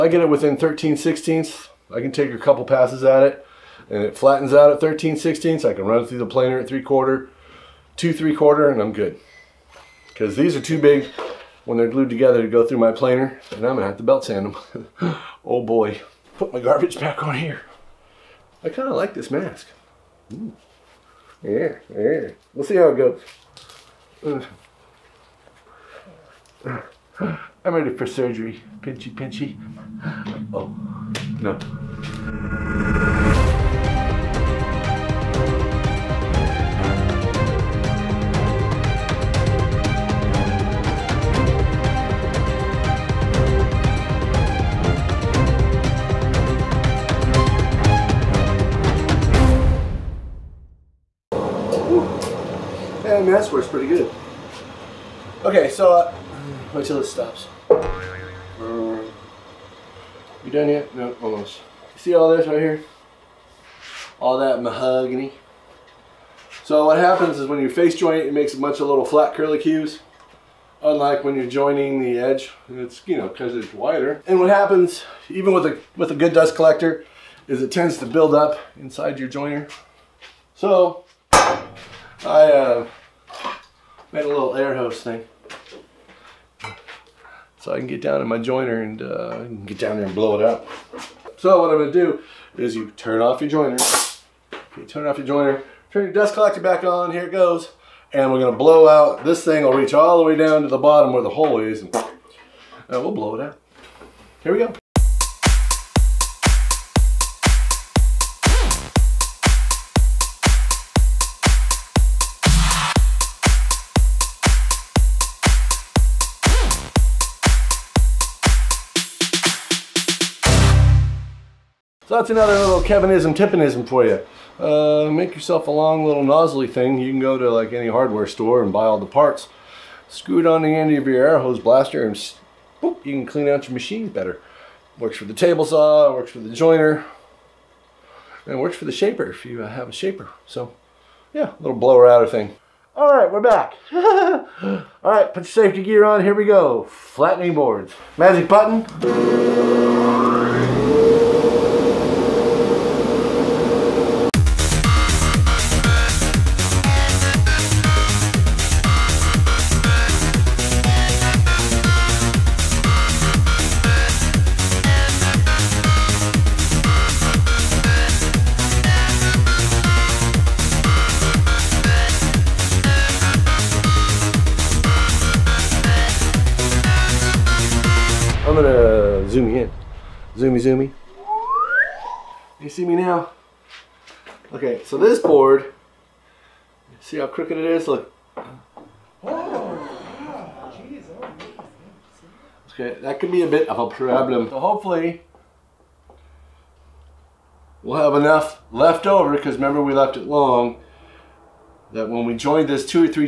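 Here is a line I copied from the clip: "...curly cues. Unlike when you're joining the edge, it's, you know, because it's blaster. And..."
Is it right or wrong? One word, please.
wrong.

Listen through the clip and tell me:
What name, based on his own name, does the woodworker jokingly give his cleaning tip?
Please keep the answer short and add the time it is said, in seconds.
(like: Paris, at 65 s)
Kevinism, at 122 s.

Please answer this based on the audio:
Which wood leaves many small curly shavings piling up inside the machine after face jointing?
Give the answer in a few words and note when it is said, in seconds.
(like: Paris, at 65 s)
Mahogany, at 64 s.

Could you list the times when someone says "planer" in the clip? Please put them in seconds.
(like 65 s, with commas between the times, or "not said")
6 s, 12 s.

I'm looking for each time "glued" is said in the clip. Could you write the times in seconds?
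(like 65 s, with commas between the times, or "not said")
11 s.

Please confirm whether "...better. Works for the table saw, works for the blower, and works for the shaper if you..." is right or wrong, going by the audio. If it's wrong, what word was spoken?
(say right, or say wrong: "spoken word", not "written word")
wrong: "joiner", not "blower".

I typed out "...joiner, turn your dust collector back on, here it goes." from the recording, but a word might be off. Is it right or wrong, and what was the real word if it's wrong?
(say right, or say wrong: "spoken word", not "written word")
right.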